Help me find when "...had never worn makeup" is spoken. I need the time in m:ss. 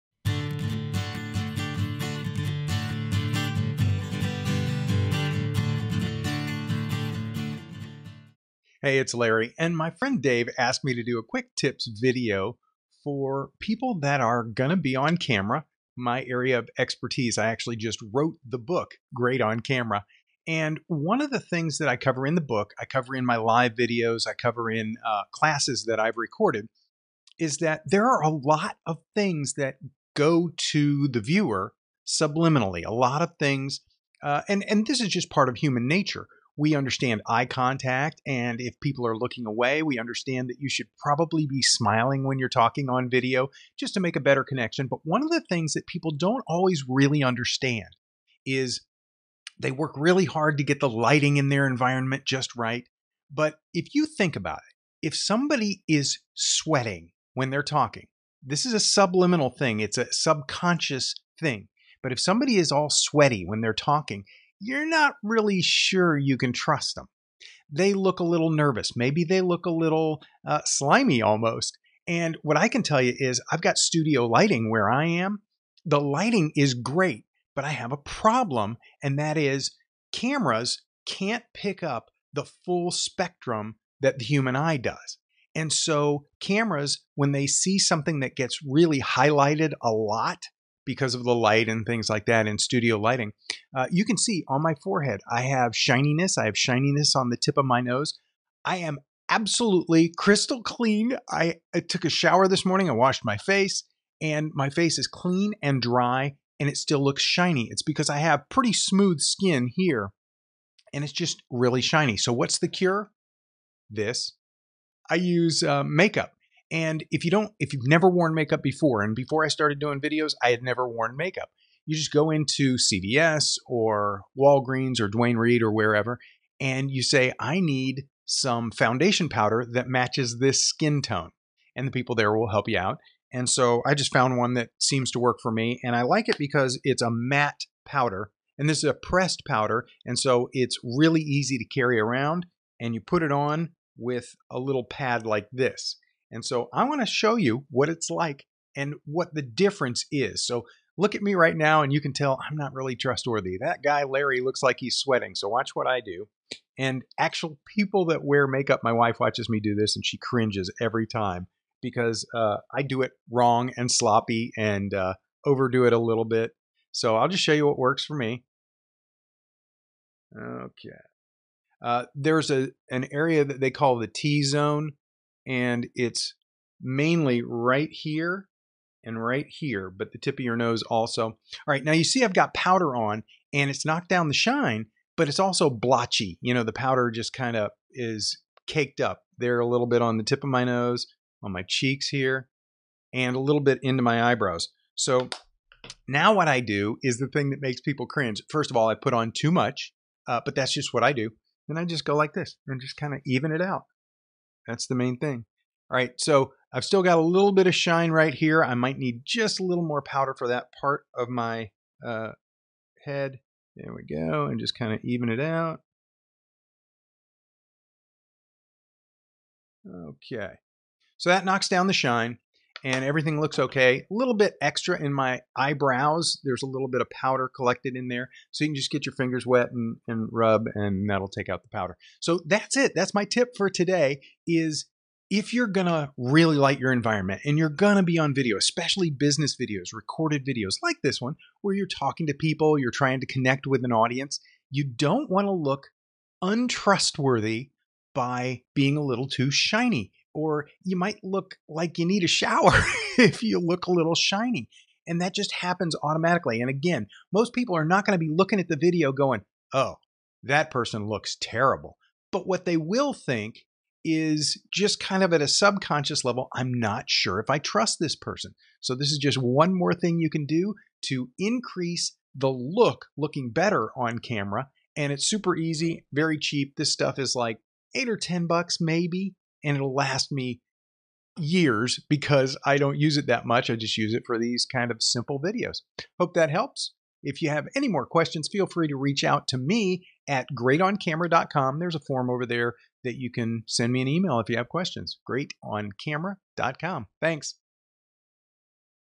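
2:00.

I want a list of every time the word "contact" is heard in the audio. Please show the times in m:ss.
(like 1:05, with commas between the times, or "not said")
0:37.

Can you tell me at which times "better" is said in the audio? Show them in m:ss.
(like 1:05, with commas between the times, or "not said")
0:44, 4:33.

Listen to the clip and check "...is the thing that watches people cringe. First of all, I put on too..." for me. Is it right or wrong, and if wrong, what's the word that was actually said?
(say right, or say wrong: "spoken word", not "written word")
wrong: "makes", not "watches".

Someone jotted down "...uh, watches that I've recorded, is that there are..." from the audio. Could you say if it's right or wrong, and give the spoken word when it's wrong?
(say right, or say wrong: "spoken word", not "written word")
wrong: "classes", not "watches".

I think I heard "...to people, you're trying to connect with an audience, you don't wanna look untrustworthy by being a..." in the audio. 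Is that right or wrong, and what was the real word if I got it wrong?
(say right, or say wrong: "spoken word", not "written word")
right.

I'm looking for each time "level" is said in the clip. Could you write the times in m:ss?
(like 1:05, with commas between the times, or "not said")
4:26.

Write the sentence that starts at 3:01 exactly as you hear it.
All right, now you see I've got powder on and it's knocked down the shine, but it's also blotchy.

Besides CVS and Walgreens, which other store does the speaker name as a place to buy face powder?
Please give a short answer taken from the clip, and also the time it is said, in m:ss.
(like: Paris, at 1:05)
Duane Reade, at 2:05.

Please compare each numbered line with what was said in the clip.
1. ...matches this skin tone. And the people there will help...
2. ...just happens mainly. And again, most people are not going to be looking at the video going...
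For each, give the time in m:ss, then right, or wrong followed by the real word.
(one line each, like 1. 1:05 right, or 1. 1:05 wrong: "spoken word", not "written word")
1. 2:09 right
2. 4:15 wrong: "automatically", not "mainly".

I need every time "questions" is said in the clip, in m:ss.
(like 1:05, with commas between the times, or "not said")
4:48, 4:54.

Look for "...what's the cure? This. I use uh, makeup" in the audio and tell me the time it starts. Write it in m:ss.
1:52.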